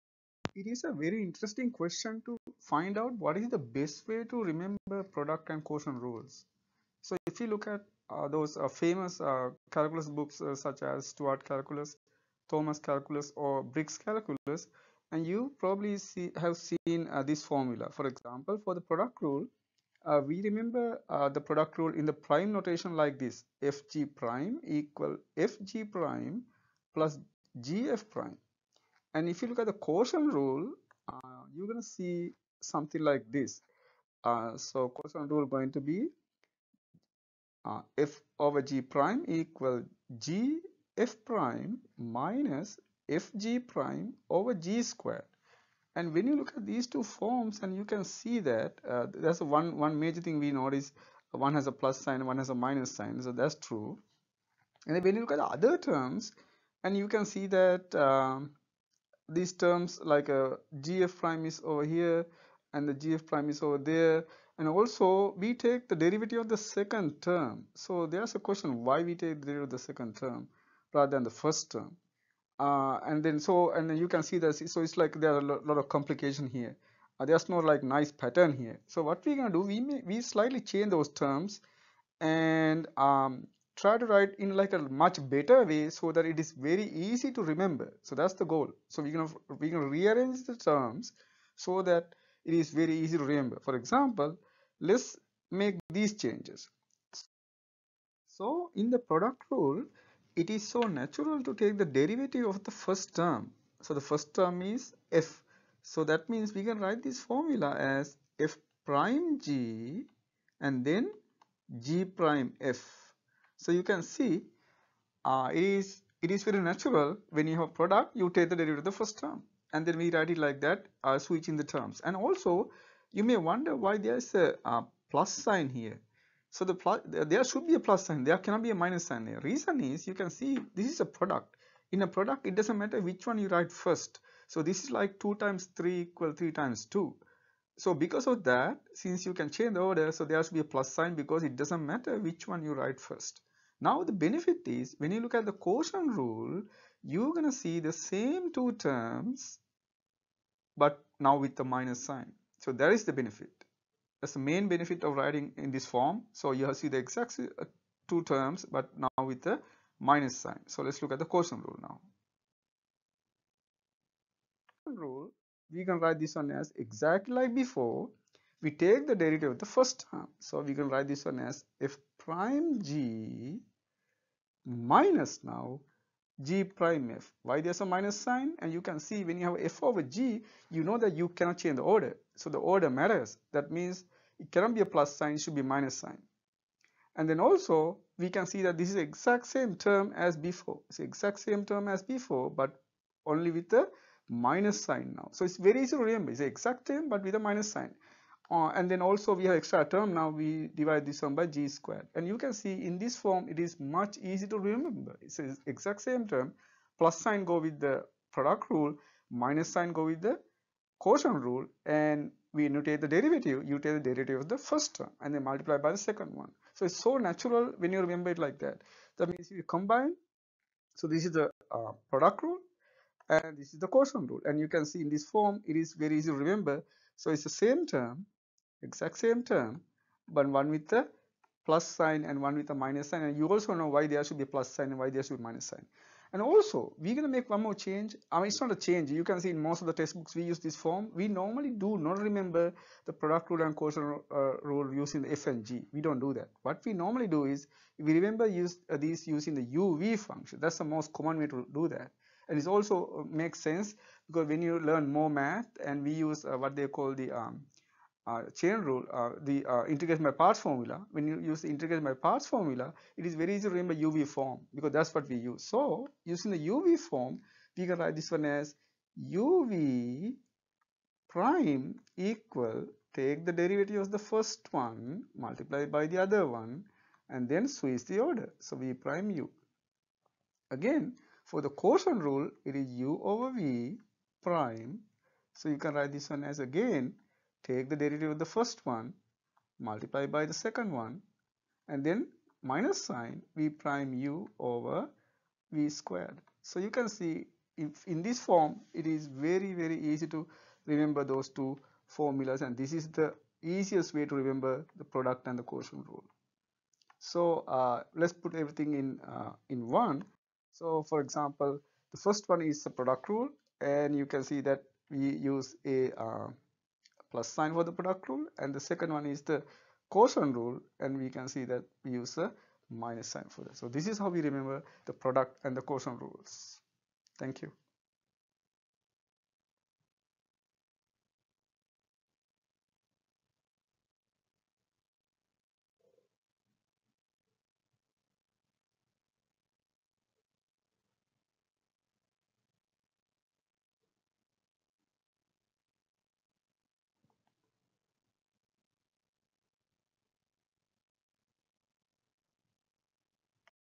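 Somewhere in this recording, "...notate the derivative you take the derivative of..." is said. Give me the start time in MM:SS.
03:32.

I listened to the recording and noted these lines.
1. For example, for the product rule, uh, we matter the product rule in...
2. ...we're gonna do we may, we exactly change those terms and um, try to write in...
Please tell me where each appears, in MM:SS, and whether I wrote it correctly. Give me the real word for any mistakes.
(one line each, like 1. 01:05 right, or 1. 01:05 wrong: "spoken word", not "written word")
1. 00:17 wrong: "remember", not "matter"
2. 01:19 wrong: "slightly", not "exactly".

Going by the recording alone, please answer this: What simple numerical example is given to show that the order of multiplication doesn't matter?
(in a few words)
2 times 3 equal 3 times 2.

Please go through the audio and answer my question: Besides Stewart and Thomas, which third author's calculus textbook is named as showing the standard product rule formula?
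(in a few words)
Briggs.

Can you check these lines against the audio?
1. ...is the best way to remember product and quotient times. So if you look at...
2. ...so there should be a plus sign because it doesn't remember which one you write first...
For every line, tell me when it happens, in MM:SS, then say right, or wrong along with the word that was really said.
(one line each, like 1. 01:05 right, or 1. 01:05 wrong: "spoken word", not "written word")
1. 00:03 wrong: "rules", not "times"
2. 02:20 wrong: "matter", not "remember".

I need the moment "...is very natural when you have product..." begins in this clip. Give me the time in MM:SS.
01:56.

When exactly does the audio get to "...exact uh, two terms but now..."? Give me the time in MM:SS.
02:36.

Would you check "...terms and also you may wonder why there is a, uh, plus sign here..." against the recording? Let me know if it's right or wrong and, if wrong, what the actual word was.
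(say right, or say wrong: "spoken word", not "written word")
right.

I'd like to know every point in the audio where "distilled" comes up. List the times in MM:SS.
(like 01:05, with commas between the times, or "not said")
not said.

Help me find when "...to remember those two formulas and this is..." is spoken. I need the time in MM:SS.
05:00.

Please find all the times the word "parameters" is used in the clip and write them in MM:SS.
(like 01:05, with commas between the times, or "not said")
not said.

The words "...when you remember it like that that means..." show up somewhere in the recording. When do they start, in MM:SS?
03:37.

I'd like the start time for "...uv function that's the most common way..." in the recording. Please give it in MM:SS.
04:09.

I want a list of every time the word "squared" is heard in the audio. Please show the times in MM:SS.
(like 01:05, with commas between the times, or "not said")
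00:44, 03:21, 04:55.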